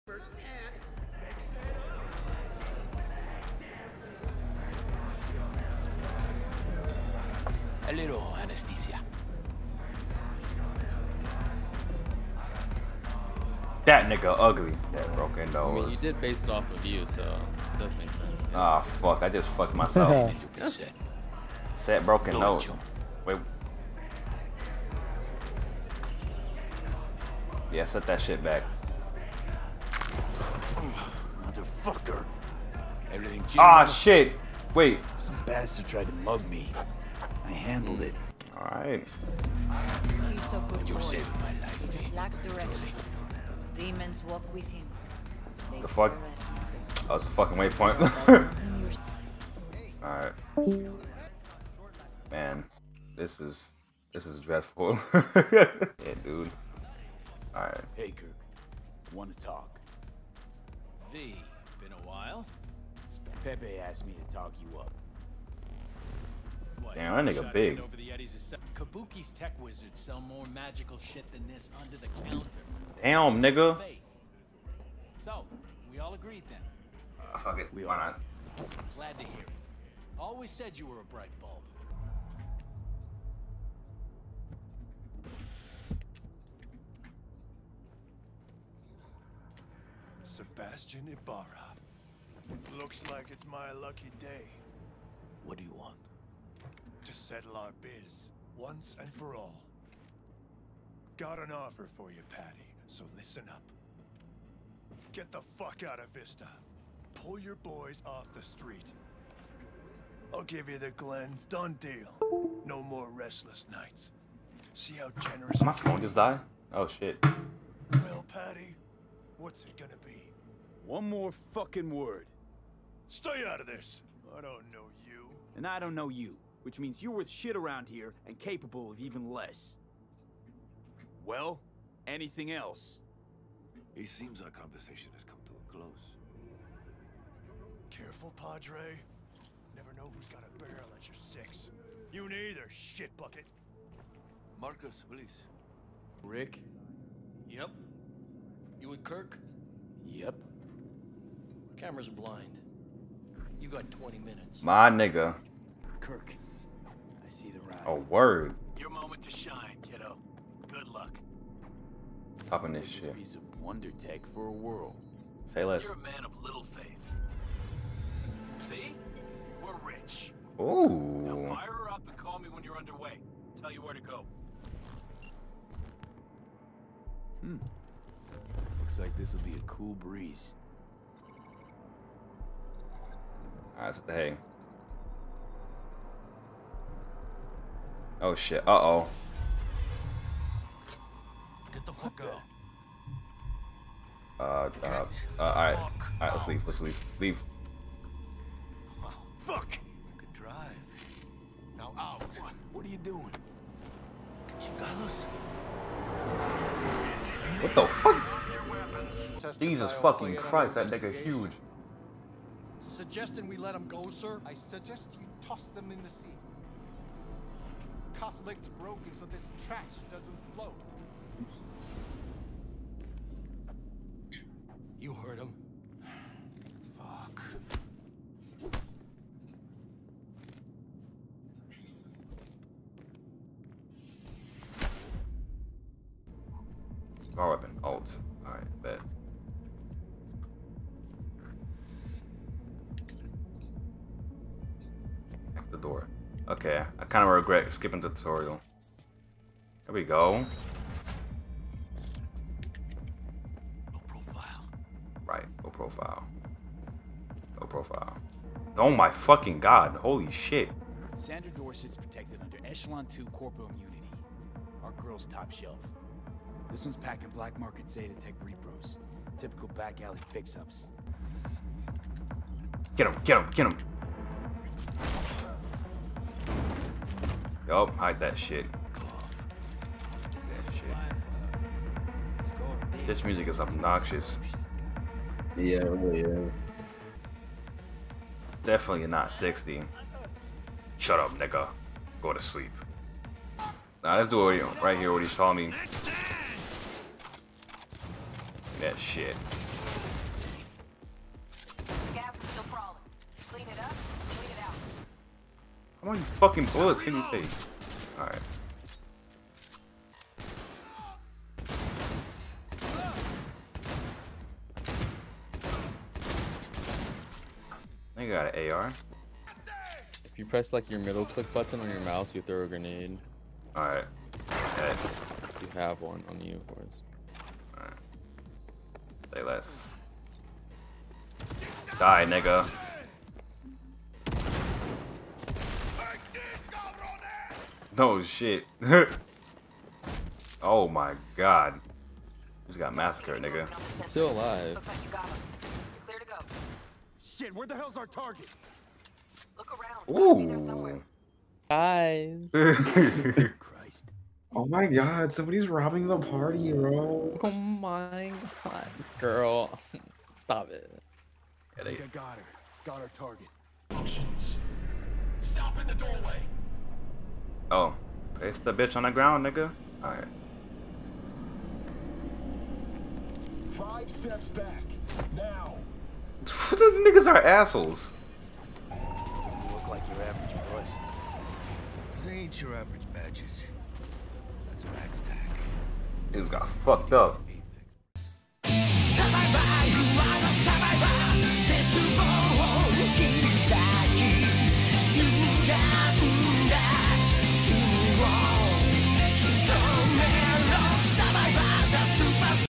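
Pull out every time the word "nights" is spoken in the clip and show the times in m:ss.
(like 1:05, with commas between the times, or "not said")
1:53.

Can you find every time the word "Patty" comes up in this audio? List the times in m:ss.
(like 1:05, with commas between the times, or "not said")
1:42, 1:58.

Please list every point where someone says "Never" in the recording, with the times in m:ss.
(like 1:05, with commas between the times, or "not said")
2:19.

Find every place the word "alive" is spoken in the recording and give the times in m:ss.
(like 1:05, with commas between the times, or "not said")
5:44.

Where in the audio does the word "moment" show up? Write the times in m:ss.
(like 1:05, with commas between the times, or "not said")
2:38.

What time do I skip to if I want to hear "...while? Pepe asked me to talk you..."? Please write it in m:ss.
1:02.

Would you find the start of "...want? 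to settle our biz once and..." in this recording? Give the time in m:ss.
1:35.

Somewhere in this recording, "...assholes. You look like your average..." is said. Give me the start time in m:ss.
6:17.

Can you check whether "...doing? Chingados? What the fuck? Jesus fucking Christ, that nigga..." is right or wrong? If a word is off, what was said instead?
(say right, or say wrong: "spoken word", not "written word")
right.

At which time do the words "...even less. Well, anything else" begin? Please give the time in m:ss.
2:08.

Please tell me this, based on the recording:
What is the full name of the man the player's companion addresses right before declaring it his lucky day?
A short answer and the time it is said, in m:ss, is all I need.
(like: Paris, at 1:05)
Sebastian Ibarra, at 1:30.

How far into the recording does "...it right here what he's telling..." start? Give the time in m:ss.
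4:54.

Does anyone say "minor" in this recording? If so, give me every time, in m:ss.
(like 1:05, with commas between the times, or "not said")
not said.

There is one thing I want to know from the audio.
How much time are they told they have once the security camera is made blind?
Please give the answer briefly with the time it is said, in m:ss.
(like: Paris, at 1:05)
20 minutes, at 2:33.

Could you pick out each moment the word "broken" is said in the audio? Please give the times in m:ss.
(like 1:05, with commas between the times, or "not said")
0:15, 0:22, 3:38.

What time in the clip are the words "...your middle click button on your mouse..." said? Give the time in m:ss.
5:20.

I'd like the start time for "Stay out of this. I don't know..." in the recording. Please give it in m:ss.
2:03.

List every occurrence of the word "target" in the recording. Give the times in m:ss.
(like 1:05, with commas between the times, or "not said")
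5:48, 6:03.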